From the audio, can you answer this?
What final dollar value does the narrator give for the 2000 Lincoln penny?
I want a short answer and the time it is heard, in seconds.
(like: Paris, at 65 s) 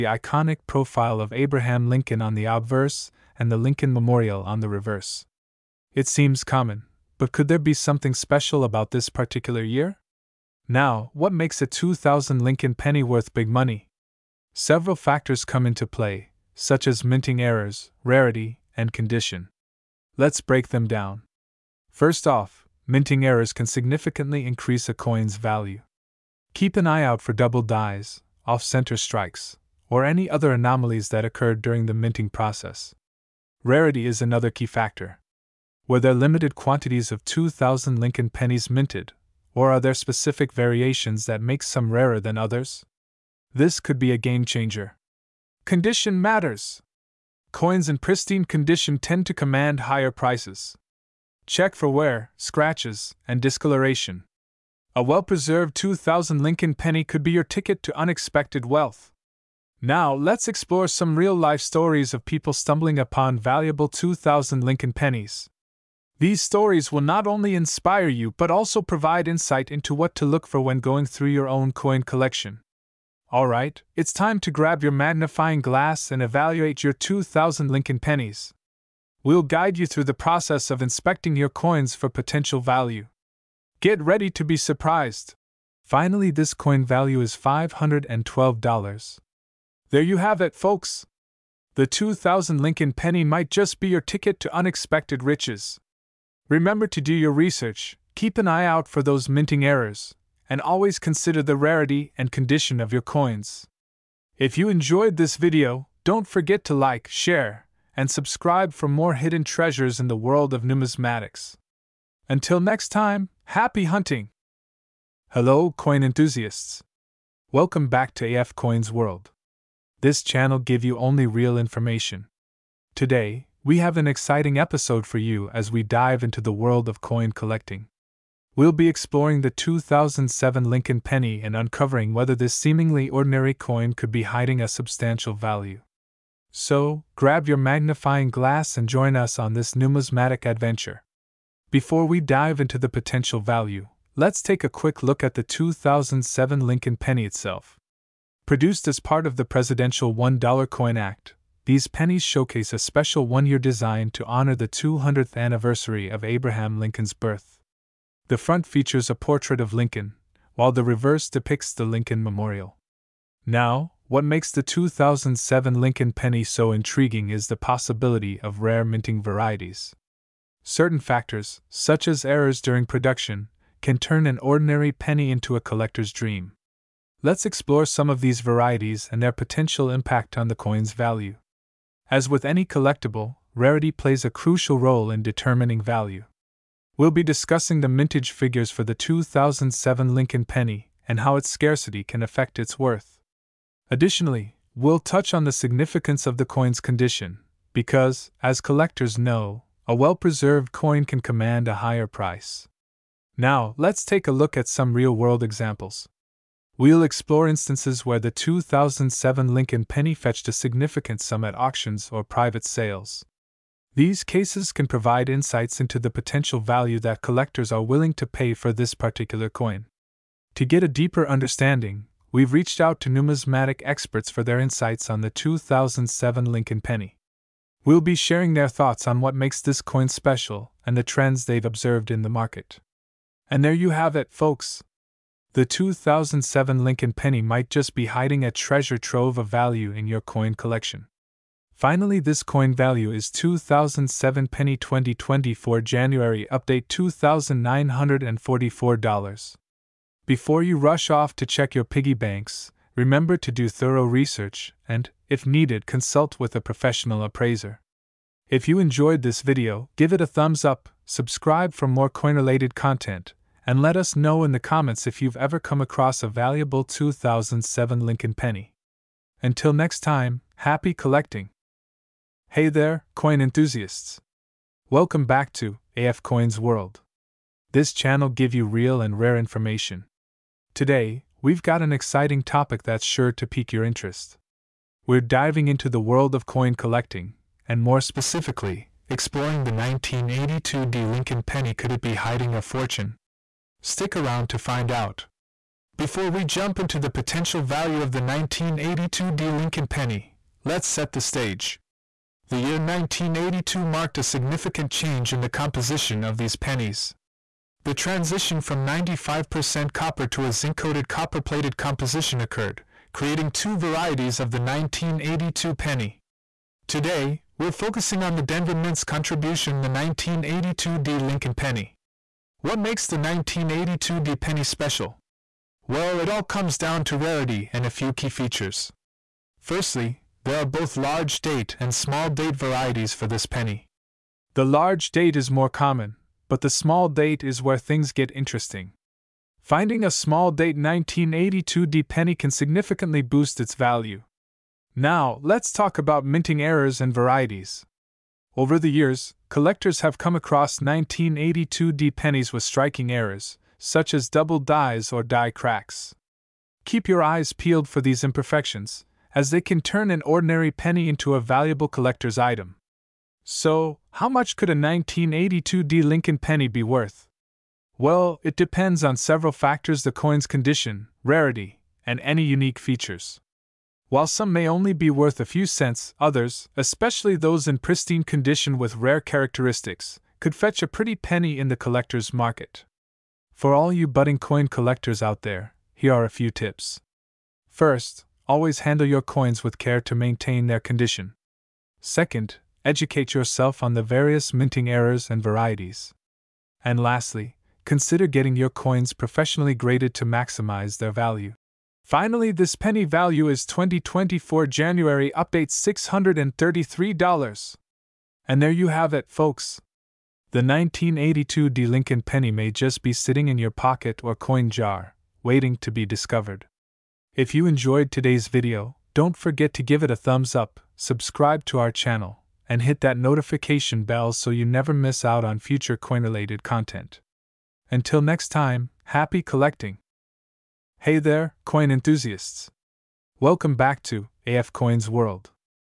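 $512, at 87 s.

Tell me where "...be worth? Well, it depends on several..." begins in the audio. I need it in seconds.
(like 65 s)
366 s.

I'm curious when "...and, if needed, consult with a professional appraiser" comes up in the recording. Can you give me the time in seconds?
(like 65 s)
254 s.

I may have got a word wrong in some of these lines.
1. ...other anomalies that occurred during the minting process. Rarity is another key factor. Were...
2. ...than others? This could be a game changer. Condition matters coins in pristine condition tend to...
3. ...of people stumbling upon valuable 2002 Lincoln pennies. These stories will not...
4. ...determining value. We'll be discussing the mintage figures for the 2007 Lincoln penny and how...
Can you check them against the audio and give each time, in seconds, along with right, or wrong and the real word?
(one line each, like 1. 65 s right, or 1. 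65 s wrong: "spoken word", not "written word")
1. 30 s right
2. 42 s right
3. 62 s wrong: "2000", not "2002"
4. 185 s right.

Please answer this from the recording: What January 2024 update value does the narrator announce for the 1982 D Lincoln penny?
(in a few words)
$633.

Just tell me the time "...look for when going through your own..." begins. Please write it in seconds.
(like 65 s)
70 s.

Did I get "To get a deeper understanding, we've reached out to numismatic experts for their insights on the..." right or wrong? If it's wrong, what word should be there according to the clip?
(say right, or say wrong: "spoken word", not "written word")
right.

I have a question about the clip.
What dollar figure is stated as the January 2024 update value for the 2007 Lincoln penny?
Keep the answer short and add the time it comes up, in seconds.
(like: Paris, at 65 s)
$2,944, at 246 s.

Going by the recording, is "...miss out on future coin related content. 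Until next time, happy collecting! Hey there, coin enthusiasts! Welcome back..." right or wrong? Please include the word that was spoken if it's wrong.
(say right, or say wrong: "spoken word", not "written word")
right.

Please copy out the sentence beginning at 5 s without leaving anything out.
It seems common, but could there be something special about this particular year?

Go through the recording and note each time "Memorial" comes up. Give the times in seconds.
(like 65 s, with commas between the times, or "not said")
3 s, 162 s.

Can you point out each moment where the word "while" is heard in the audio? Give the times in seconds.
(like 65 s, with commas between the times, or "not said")
160 s, 374 s.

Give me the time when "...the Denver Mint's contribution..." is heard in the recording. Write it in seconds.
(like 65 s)
318 s.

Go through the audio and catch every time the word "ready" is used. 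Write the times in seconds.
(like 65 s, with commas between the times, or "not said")
84 s.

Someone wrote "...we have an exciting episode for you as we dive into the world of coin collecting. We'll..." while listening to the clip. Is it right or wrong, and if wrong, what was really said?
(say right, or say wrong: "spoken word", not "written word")
right.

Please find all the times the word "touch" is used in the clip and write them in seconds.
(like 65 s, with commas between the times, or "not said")
195 s.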